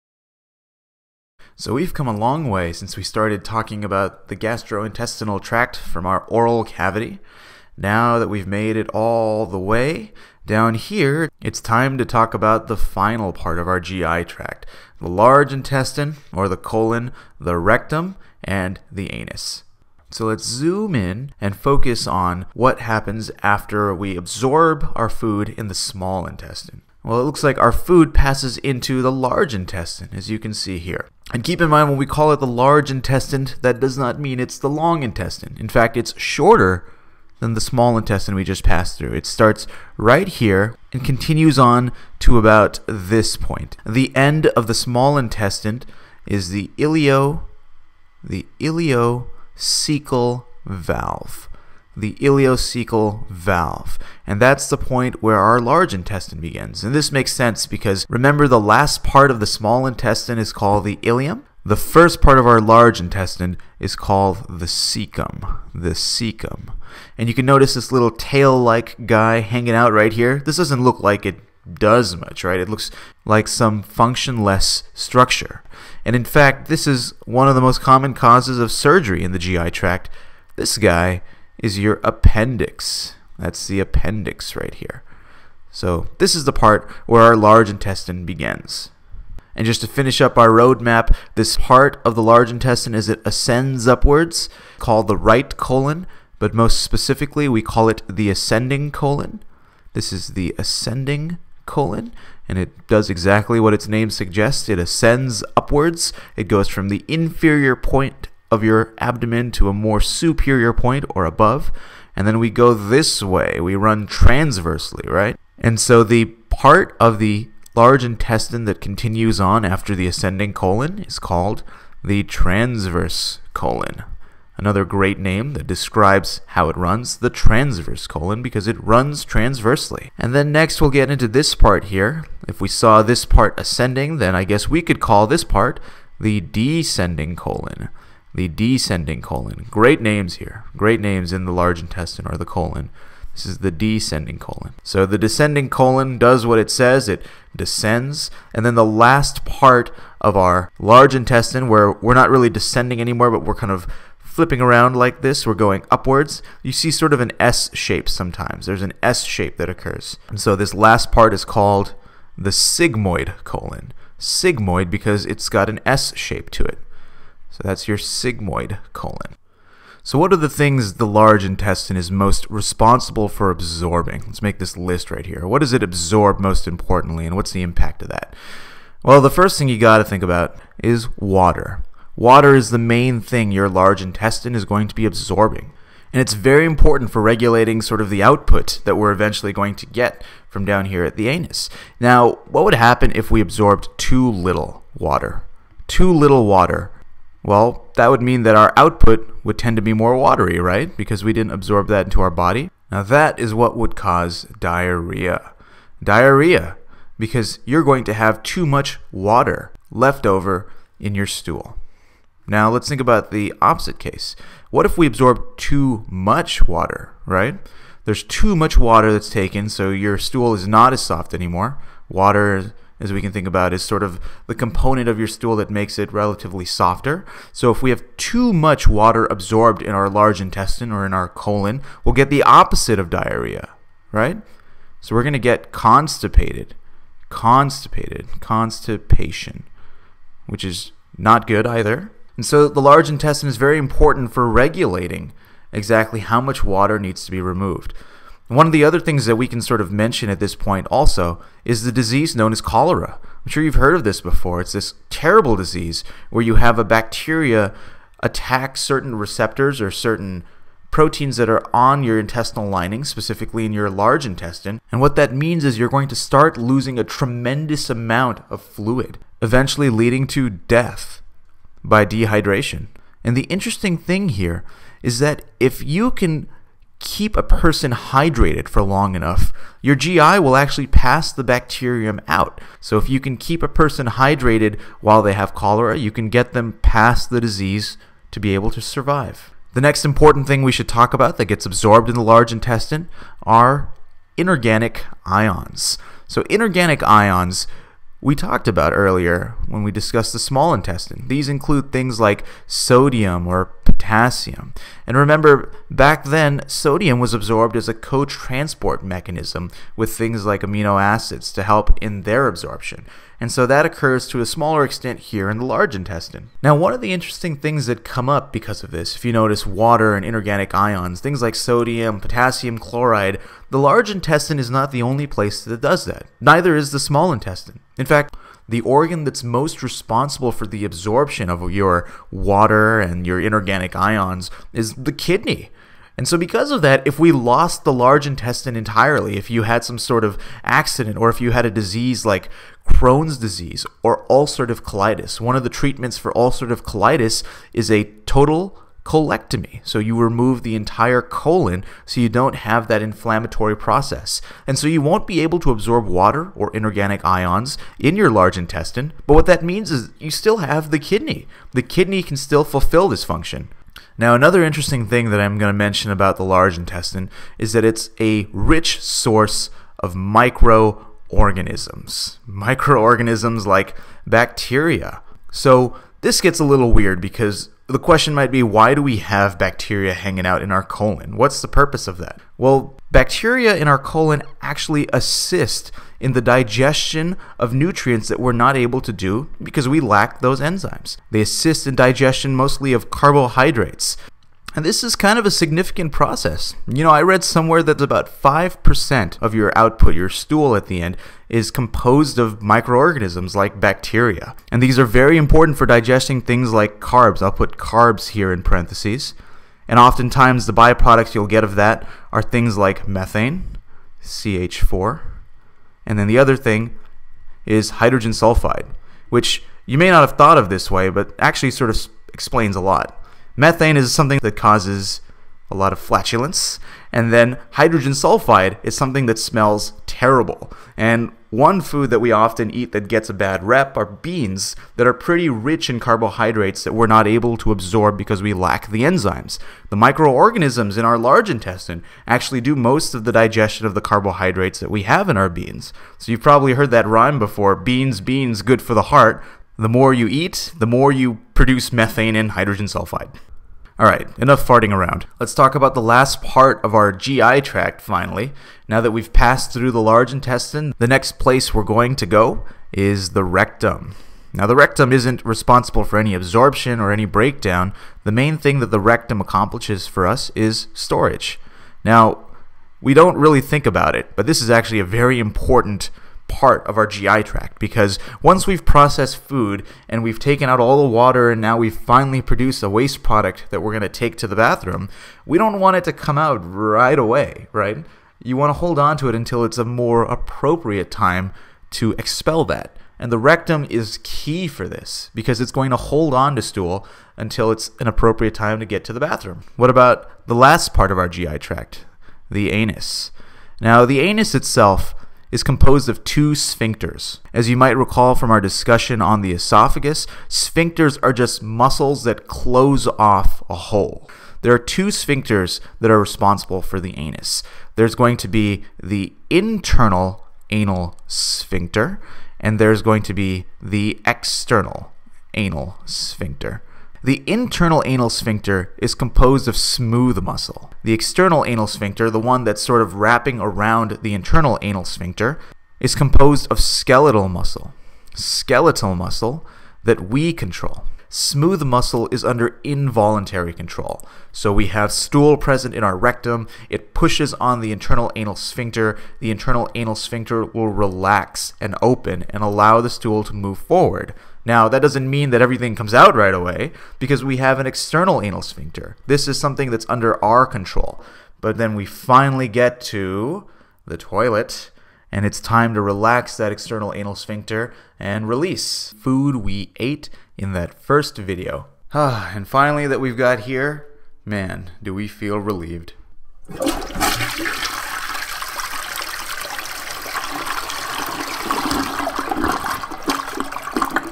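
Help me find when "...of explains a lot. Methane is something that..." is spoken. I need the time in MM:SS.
07:01.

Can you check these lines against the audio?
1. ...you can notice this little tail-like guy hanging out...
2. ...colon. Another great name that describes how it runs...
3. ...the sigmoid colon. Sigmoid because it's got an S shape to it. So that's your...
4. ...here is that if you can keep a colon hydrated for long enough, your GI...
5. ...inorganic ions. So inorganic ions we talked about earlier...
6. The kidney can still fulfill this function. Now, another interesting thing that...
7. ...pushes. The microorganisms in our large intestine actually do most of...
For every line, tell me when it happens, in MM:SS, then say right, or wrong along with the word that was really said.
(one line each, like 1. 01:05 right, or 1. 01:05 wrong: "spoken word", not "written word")
1. 01:07 right
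2. 02:03 right
3. 02:42 right
4. 04:34 wrong: "person", not "colon"
5. 04:54 right
6. 06:01 right
7. 07:19 wrong: "enzymes", not "pushes".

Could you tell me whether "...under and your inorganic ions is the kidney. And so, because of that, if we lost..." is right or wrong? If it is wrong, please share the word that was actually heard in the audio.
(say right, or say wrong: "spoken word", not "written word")
wrong: "water", not "under".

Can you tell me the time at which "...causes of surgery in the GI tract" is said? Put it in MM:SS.
01:18.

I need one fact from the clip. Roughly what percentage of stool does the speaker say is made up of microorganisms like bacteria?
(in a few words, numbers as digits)
5%.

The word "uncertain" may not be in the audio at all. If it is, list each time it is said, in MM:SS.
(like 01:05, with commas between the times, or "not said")
not said.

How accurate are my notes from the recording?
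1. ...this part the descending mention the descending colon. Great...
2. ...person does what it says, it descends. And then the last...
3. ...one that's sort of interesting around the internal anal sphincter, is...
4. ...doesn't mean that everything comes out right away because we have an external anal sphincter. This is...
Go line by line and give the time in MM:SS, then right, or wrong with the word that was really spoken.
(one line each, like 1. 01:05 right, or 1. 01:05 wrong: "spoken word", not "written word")
1. 02:15 wrong: "colon", not "mention"
2. 02:25 wrong: "colon", not "person"
3. 08:52 wrong: "wrapping", not "interesting"
4. 09:15 right.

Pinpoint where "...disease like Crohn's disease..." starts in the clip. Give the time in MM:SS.
05:41.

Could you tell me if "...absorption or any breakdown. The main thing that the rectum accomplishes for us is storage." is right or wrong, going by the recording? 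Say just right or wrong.
right.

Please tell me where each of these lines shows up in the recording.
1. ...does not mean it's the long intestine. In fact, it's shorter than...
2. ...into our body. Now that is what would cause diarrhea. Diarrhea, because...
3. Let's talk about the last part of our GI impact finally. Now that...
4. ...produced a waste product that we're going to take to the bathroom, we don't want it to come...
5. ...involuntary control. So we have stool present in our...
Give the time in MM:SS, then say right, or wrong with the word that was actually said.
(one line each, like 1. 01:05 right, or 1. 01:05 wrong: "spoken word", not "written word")
1. 00:33 right
2. 03:22 right
3. 07:35 wrong: "tract", not "impact"
4. 08:02 right
5. 09:02 right.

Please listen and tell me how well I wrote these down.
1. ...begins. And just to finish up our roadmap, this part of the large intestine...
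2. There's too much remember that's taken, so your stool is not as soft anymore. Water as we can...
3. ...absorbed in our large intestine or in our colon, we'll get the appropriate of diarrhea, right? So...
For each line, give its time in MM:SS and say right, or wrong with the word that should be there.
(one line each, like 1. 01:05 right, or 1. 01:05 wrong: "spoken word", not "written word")
1. 01:28 right
2. 03:38 wrong: "water", not "remember"
3. 03:49 wrong: "opposite", not "appropriate".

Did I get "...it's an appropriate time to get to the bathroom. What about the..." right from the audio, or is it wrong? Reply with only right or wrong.
right.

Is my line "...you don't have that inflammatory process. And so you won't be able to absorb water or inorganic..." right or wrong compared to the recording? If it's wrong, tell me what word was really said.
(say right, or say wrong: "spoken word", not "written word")
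right.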